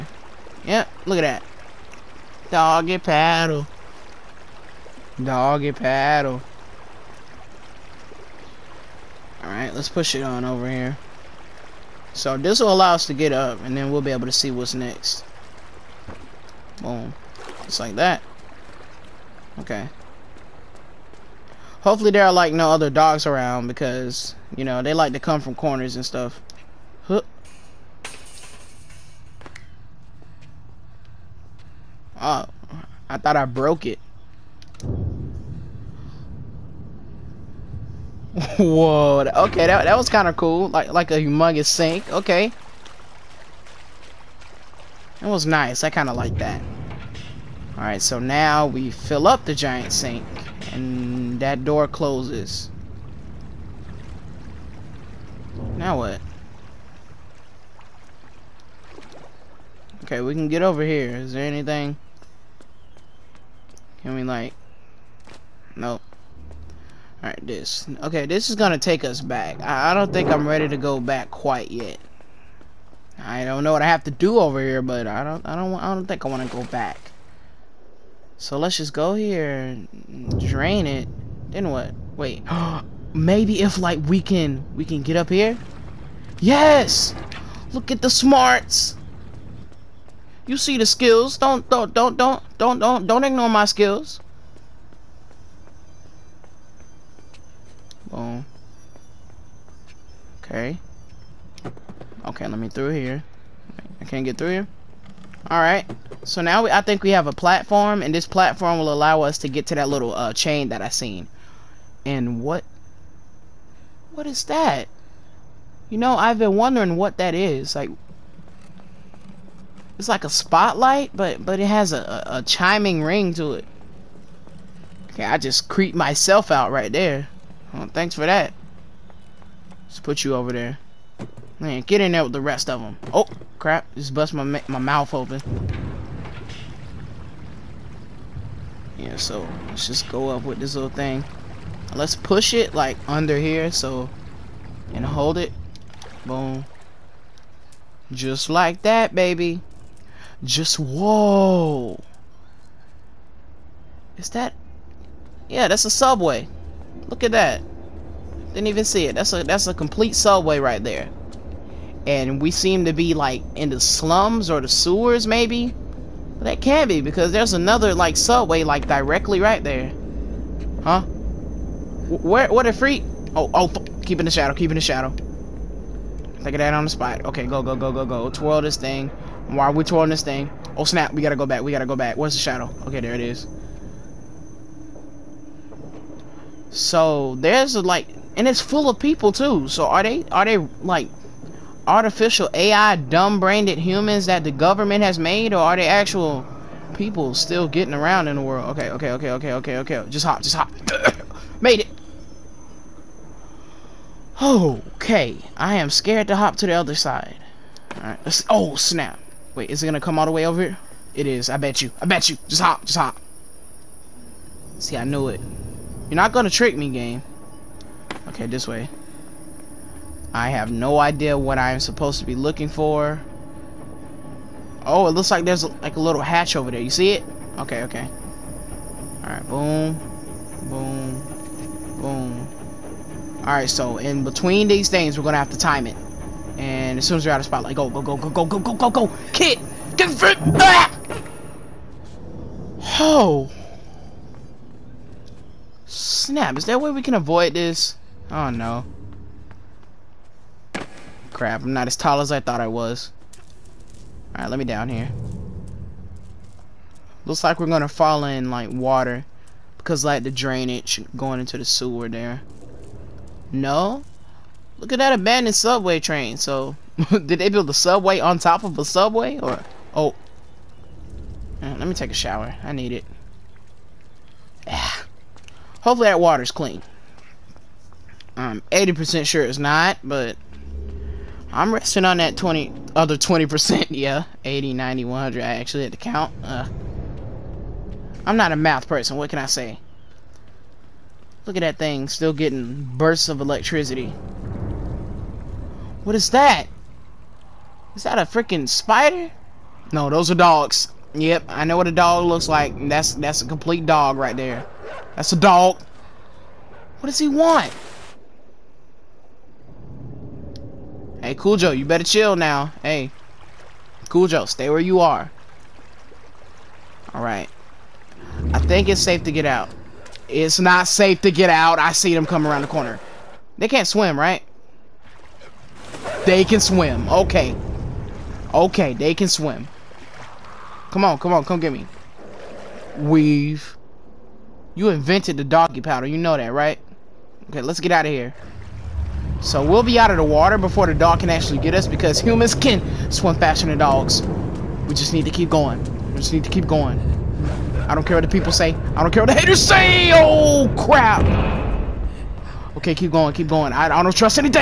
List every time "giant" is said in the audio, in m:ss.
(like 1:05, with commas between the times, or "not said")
0:49.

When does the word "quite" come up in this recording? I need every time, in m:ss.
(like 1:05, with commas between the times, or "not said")
1:11.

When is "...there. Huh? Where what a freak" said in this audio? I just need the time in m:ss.
2:49.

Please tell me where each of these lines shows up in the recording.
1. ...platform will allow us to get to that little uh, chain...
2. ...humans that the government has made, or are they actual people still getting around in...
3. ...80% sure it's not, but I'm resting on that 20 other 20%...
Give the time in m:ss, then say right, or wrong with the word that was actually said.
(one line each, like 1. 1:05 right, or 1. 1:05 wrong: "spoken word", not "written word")
1. 1:48 right
2. 3:13 right
3. 4:38 right.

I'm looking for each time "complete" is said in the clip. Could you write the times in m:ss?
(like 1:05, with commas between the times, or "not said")
2:39, 5:03.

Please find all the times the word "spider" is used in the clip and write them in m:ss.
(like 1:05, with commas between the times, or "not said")
4:58.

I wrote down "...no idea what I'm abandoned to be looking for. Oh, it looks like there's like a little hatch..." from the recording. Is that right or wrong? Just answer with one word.
wrong.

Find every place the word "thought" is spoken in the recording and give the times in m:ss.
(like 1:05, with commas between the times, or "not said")
0:33, 4:12.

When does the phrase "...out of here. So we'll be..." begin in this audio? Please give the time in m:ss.
5:37.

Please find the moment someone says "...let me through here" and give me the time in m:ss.
1:42.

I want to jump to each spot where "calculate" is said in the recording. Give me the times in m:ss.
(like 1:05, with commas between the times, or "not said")
not said.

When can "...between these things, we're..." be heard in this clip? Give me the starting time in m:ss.
3:54.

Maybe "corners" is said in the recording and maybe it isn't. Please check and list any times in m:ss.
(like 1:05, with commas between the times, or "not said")
0:25, 5:22.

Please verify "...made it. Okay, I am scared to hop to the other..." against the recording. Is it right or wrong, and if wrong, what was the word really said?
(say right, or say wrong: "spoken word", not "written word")
right.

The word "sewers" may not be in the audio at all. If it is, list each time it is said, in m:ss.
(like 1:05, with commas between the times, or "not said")
2:44, 4:21.